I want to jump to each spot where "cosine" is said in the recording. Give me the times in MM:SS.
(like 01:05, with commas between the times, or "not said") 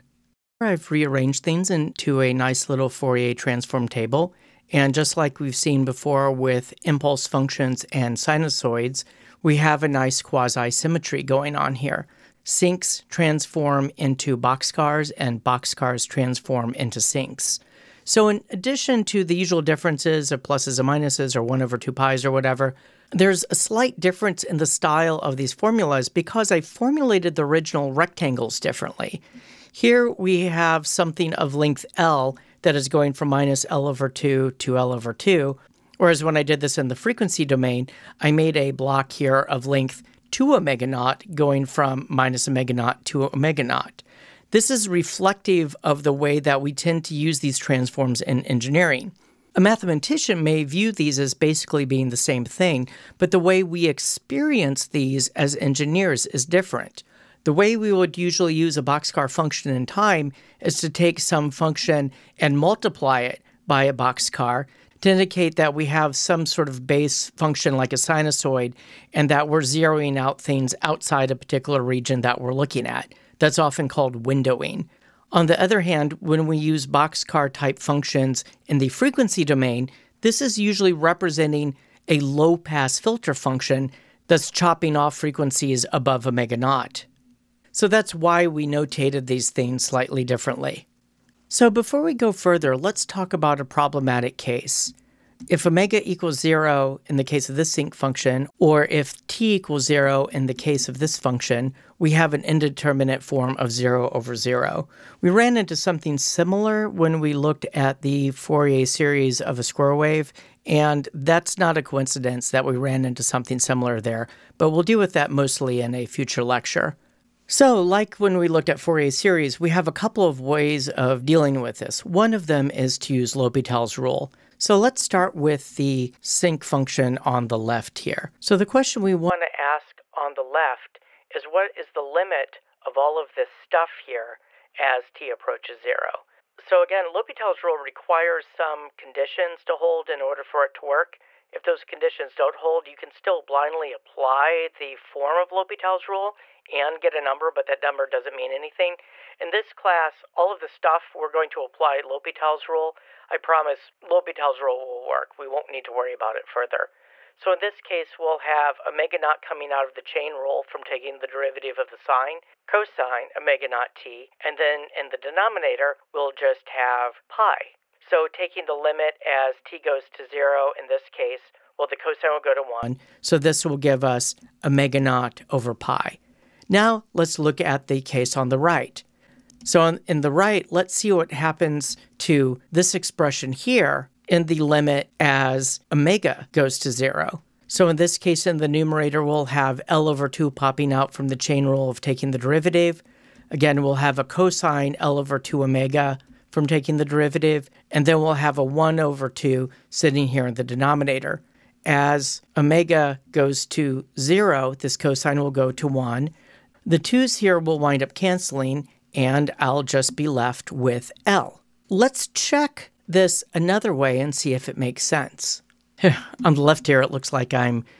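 02:42, 02:51, 03:14, 03:24.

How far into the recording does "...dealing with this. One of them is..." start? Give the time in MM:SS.
02:01.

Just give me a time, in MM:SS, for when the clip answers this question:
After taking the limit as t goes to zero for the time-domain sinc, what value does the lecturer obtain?
02:54.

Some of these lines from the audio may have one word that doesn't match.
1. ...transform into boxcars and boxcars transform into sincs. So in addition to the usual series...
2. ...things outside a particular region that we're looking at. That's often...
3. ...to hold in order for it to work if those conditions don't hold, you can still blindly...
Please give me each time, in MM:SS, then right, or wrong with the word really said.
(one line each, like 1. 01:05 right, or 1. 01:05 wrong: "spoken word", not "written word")
1. 00:13 wrong: "differences", not "series"
2. 01:10 right
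3. 02:19 right.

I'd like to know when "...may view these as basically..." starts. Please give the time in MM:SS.
00:50.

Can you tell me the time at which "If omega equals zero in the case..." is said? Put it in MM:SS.
01:35.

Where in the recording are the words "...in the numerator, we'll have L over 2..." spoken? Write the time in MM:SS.
03:08.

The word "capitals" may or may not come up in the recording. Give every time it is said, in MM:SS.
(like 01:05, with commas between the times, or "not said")
not said.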